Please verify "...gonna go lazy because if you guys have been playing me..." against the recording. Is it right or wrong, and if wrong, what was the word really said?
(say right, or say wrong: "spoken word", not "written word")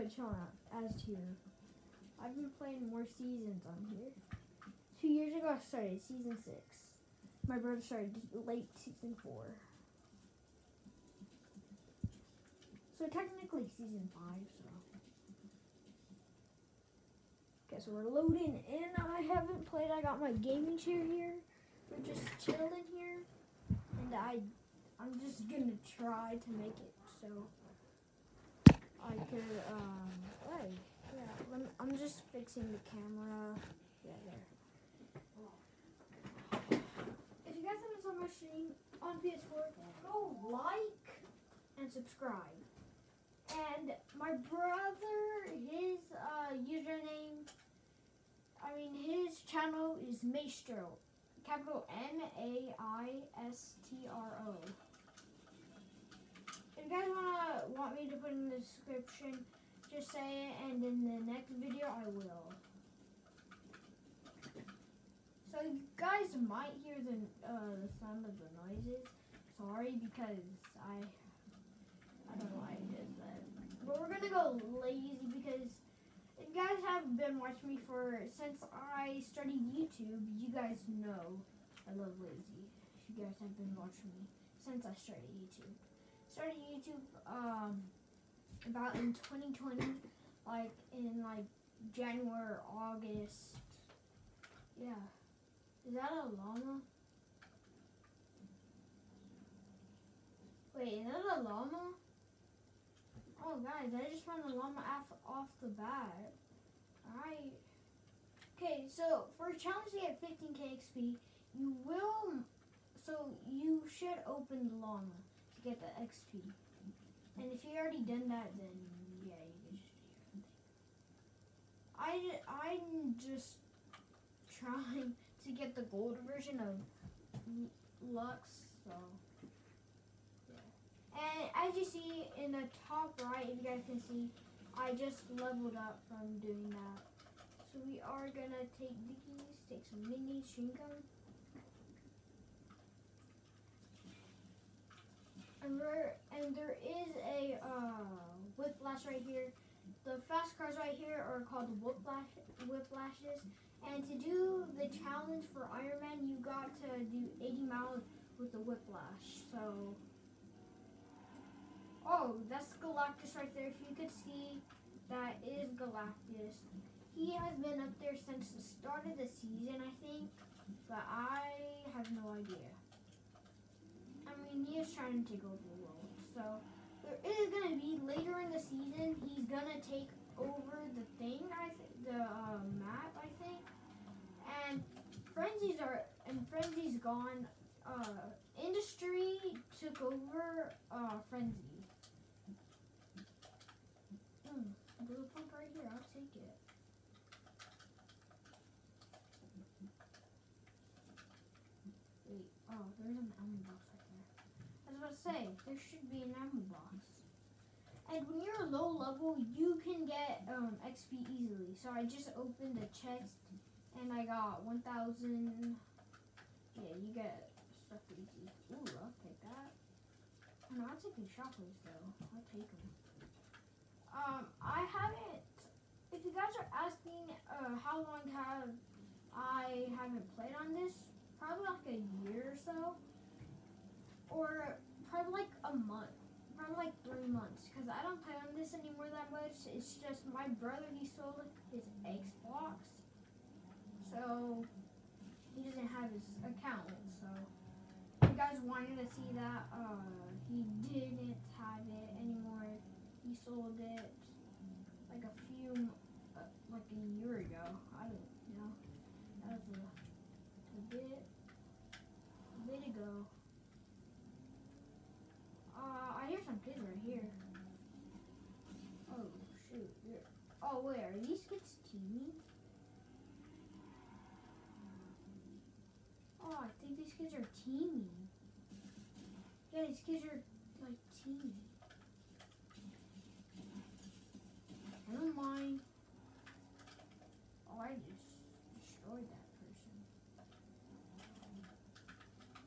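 wrong: "watching", not "playing".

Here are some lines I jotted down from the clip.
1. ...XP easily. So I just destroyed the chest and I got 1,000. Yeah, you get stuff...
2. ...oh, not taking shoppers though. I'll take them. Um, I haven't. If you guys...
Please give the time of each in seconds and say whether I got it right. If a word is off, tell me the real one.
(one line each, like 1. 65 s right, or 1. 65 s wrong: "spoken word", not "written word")
1. 210 s wrong: "opened", not "destroyed"
2. 220 s right.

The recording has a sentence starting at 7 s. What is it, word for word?
My brother started late season four.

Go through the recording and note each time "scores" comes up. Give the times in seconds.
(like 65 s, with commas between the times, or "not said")
not said.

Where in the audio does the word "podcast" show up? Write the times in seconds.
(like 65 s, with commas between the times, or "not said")
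not said.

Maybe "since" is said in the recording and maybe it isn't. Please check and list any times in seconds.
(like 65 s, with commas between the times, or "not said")
78 s, 84 s, 168 s.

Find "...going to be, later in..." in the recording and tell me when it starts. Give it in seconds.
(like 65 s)
177 s.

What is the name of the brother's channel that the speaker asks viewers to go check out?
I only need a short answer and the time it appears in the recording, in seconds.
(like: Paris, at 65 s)
Maestro, at 50 s.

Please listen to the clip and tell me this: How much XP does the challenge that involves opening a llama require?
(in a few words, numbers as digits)
15k XP.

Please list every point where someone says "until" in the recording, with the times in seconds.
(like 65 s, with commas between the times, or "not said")
not said.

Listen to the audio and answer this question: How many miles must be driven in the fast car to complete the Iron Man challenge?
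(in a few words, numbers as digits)
80.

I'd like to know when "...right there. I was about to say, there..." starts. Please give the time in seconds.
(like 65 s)
203 s.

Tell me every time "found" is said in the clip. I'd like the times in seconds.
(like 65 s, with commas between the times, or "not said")
104 s.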